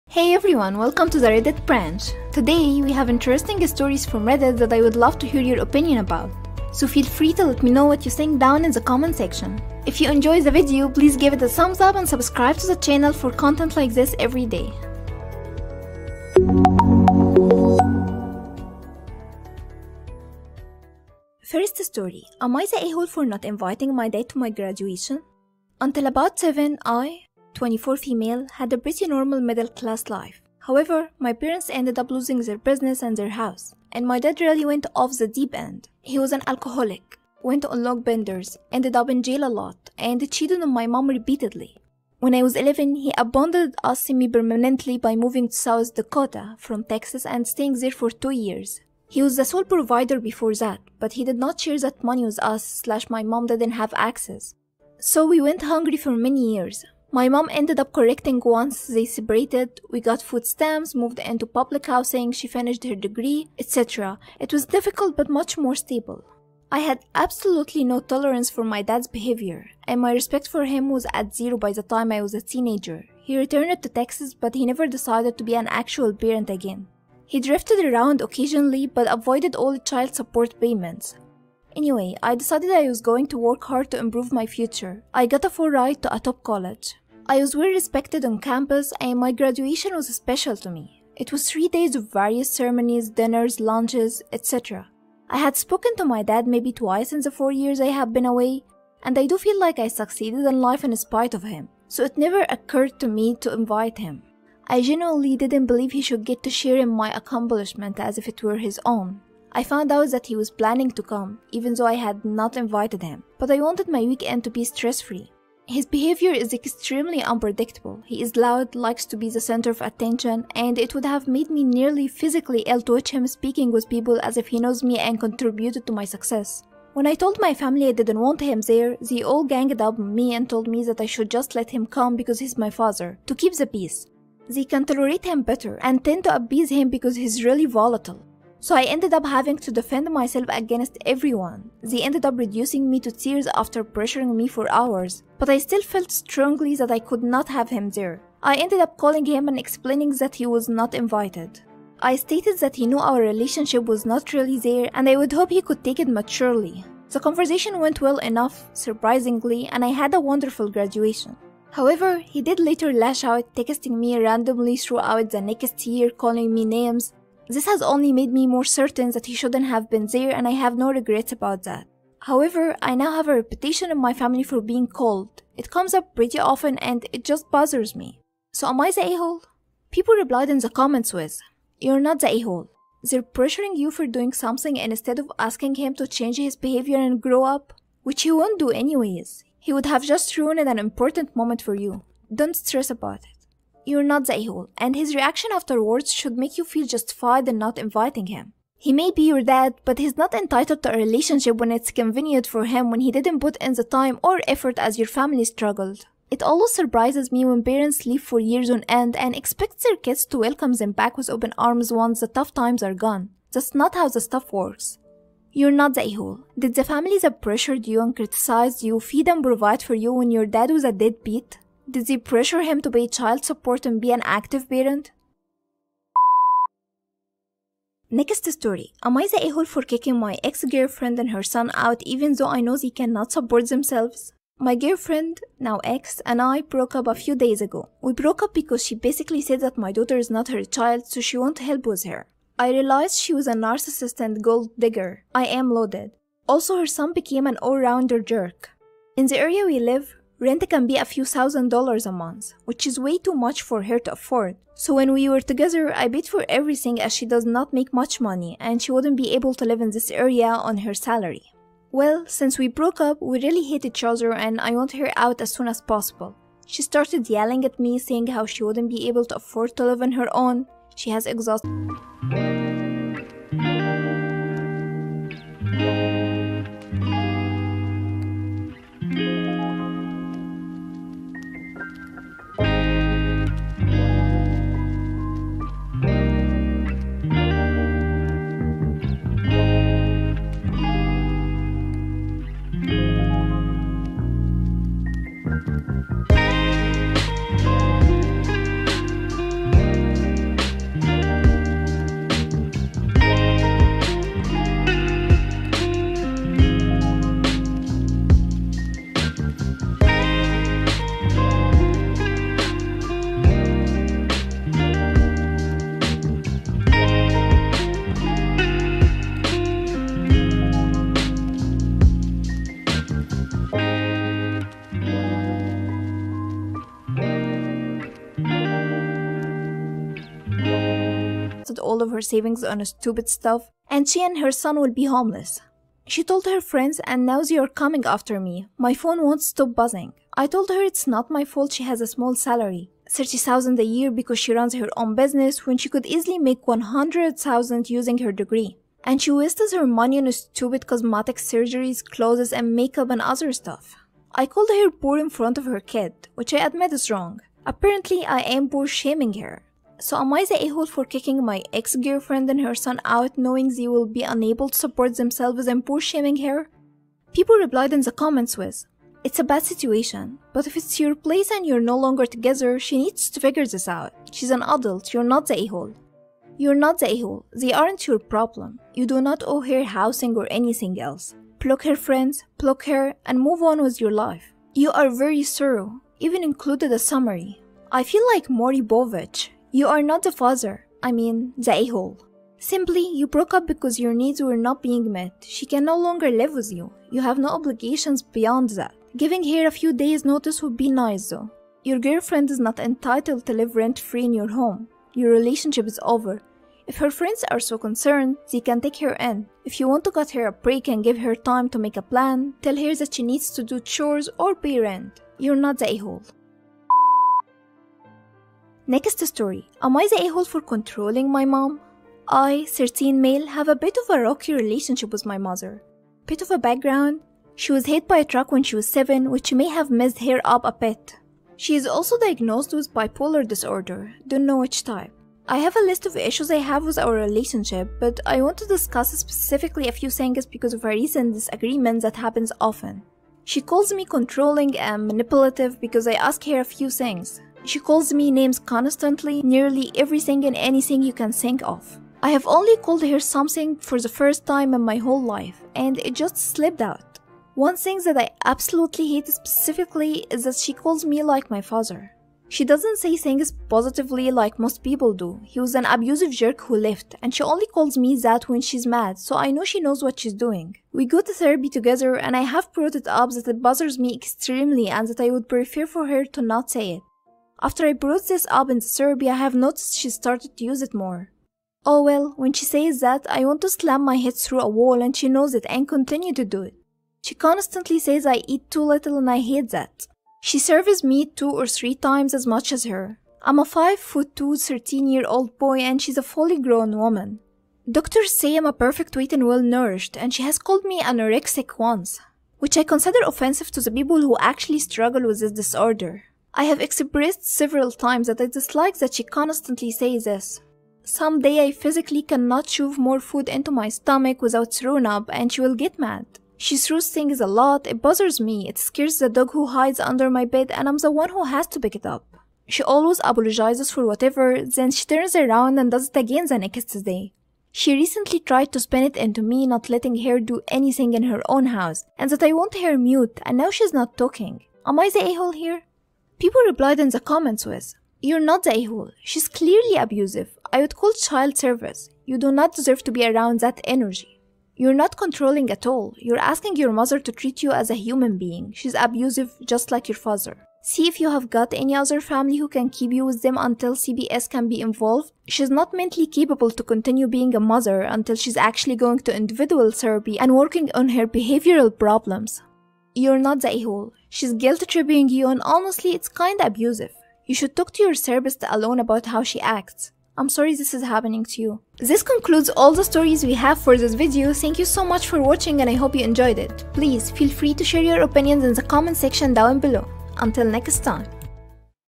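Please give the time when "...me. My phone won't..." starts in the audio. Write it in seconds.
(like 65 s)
338 s.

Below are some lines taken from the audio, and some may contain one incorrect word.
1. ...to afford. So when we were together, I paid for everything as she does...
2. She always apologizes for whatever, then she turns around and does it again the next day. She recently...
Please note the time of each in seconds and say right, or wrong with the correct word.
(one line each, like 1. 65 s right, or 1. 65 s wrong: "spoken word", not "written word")
1. 253 s right
2. 522 s right.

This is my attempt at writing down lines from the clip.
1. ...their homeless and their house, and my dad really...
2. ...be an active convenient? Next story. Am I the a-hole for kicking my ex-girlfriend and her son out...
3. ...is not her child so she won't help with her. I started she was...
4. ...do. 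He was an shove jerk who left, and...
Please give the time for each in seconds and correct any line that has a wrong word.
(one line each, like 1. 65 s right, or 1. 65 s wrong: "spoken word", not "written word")
1. 32 s wrong: "business", not "homeless"
2. 223 s wrong: "parent", not "convenient"
3. 240 s wrong: "realized", not "started"
4. 465 s wrong: "abusive", not "shove".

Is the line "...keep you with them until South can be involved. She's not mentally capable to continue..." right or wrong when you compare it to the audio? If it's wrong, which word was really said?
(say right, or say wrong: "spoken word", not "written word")
wrong: "CPS", not "South".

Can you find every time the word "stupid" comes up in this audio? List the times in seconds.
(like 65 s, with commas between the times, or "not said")
332 s, 350 s.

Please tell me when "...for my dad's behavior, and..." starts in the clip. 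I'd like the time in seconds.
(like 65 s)
68 s.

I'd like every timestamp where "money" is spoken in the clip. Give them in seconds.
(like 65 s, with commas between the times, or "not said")
52 s, 258 s, 349 s.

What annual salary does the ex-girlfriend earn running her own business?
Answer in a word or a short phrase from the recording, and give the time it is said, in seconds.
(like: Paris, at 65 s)
30,000, at 343 s.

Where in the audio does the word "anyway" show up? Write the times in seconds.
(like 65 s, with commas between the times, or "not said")
81 s, 188 s.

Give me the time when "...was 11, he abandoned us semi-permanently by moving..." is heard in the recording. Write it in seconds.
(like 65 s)
42 s.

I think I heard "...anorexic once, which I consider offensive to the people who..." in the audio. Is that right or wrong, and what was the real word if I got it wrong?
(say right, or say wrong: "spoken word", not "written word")
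right.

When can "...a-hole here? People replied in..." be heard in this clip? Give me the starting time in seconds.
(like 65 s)
535 s.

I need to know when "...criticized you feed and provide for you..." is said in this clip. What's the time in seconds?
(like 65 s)
218 s.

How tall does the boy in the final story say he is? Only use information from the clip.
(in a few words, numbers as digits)
5 foot 2.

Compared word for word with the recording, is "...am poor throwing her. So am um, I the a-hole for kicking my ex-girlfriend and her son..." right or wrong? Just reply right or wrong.
wrong.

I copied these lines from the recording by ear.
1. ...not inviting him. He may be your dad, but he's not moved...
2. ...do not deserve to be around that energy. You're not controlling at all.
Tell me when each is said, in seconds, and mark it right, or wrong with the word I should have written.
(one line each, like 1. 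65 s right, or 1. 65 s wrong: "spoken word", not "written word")
1. 197 s wrong: "entitled", not "moved"
2. 542 s right.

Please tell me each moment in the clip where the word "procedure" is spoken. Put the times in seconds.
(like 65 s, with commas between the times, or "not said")
not said.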